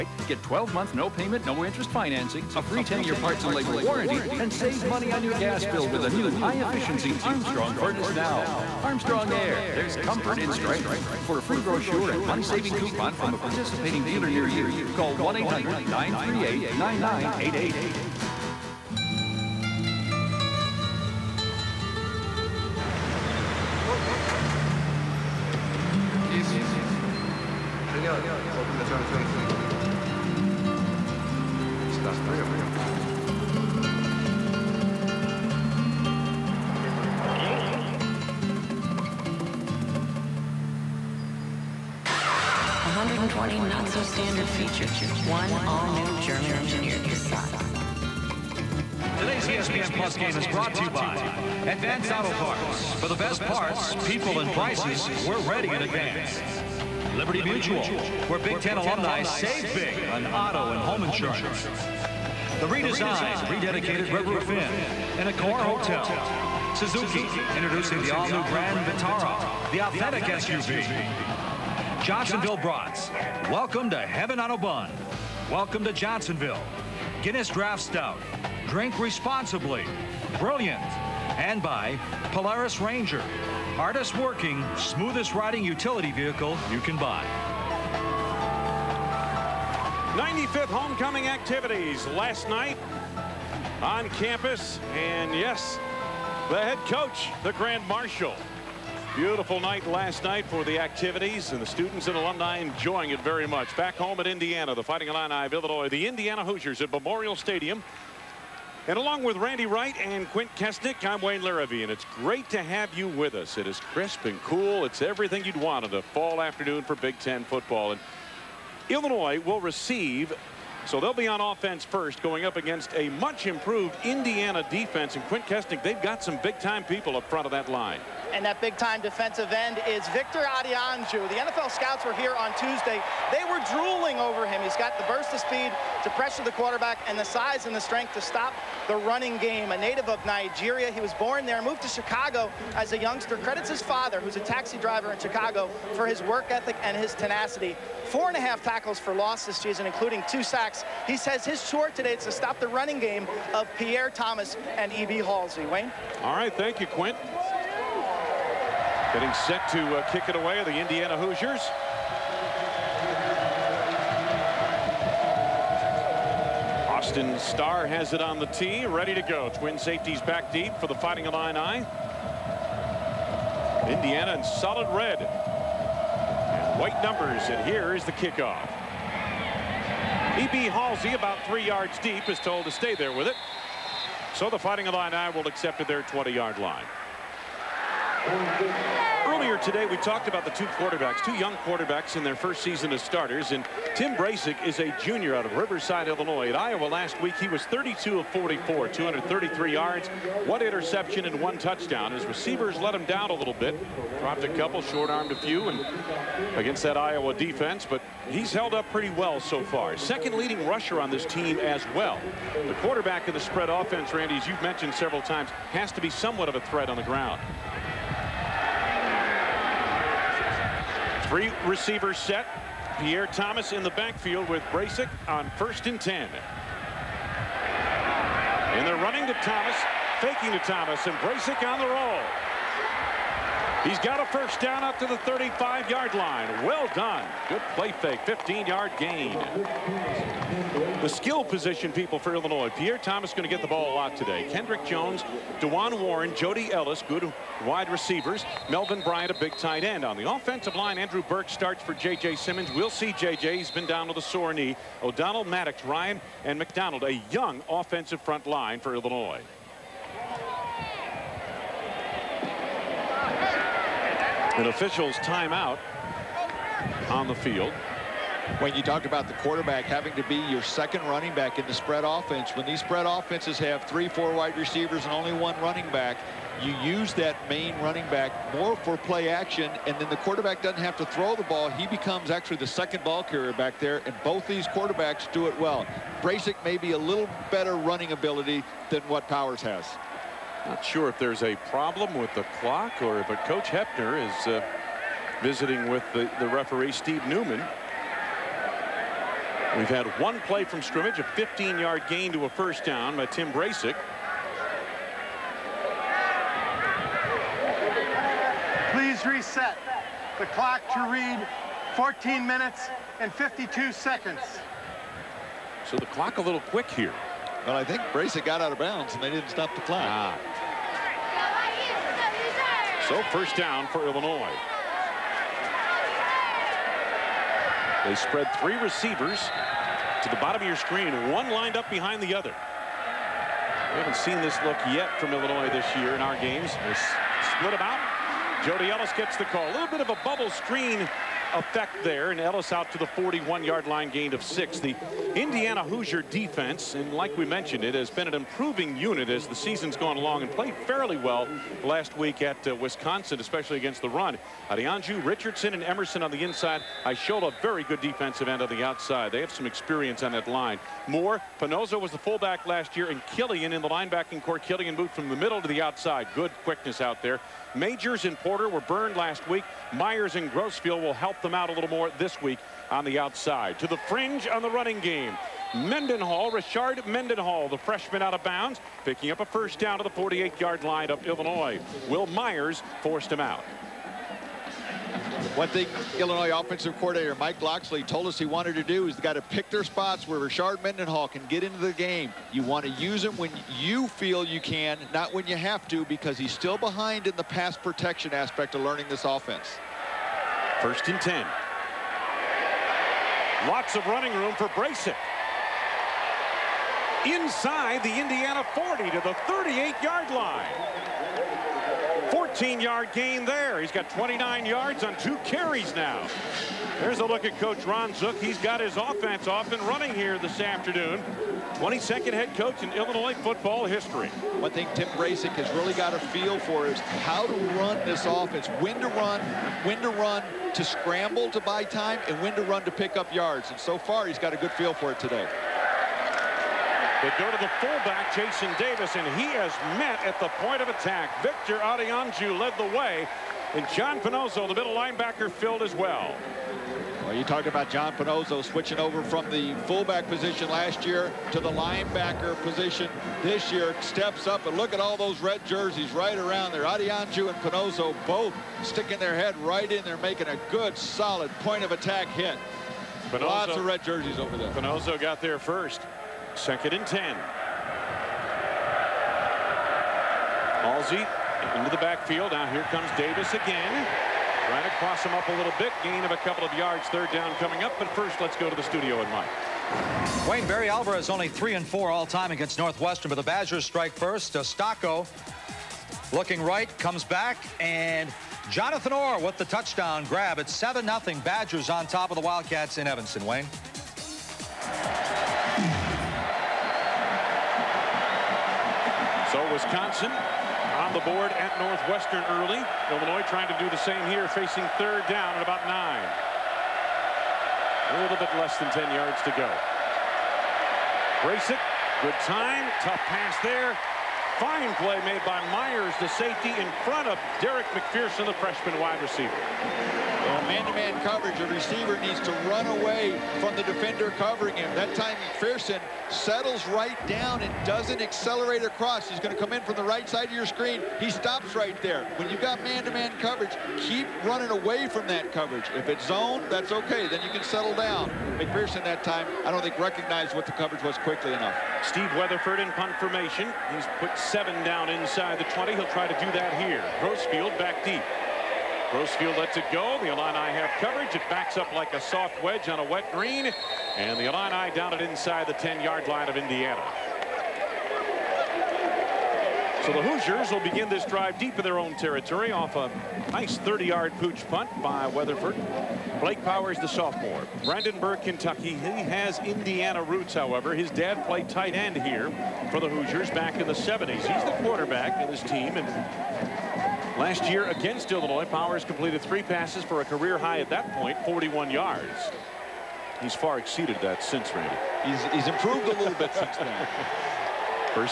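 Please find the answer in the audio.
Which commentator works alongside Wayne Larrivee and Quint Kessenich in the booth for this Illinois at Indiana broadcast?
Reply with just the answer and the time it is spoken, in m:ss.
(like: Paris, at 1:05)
Randy Wright, at 1:49.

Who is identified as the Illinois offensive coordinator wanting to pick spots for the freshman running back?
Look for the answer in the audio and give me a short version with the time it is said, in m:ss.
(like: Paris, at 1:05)
Mike Locksley, at 6:27.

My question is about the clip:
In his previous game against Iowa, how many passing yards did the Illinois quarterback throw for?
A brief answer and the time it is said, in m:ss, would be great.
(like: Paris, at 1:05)
233, at 3:18.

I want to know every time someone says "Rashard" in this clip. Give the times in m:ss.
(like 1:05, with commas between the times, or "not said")
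6:16, 6:30.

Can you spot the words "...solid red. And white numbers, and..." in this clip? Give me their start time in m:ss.
2:54.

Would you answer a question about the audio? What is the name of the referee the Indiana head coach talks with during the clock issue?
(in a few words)
Steve Newman.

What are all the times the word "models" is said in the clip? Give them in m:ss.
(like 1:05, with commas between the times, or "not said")
not said.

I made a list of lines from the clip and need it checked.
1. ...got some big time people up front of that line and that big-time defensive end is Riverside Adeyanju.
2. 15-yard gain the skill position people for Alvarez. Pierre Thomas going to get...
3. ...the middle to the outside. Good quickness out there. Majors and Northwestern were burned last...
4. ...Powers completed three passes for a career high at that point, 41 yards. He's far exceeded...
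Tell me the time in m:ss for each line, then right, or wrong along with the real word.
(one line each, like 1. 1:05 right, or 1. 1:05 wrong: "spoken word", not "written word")
1. 2:06 wrong: "Victor", not "Riverside"
2. 3:58 wrong: "Illinois", not "Alvarez"
3. 6:05 wrong: "Porter", not "Northwestern"
4. 9:38 right.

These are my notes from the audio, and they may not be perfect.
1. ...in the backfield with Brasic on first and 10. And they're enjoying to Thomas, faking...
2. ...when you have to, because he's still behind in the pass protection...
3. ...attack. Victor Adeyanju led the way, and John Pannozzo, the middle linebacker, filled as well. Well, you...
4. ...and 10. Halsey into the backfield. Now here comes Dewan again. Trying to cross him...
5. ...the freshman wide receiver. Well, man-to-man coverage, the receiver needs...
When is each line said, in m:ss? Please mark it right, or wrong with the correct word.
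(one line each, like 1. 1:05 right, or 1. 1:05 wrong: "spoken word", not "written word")
1. 3:43 wrong: "running", not "enjoying"
2. 6:35 right
3. 7:20 right
4. 7:46 wrong: "Davis", not "Dewan"
5. 8:38 right.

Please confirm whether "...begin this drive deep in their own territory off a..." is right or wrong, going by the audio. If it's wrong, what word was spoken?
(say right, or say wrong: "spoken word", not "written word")
right.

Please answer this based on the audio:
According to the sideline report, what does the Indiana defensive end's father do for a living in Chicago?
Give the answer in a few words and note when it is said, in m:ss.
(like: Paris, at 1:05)
Taxi driver, at 2:24.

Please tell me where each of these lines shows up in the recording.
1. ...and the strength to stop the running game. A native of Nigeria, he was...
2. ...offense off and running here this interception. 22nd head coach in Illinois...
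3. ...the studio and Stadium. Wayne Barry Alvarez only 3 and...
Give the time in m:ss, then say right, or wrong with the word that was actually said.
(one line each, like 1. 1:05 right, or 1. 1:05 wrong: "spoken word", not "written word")
1. 2:17 right
2. 6:58 wrong: "afternoon", not "interception"
3. 7:58 wrong: "Mike", not "Stadium".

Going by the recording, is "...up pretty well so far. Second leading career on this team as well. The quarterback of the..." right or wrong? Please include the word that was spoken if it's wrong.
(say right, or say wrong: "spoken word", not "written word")
wrong: "rusher", not "career".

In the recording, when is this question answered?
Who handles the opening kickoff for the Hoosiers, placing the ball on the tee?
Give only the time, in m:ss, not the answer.
2:46.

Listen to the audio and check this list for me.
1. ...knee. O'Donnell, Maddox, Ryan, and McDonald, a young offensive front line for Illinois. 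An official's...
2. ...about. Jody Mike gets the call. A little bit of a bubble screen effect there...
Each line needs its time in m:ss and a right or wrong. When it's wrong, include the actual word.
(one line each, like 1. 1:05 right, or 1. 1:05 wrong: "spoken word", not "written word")
1. 4:14 right
2. 5:37 wrong: "Ellis", not "Mike".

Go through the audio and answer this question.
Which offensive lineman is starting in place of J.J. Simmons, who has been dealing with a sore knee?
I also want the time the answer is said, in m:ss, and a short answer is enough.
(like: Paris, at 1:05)
Andrew Burke, at 4:10.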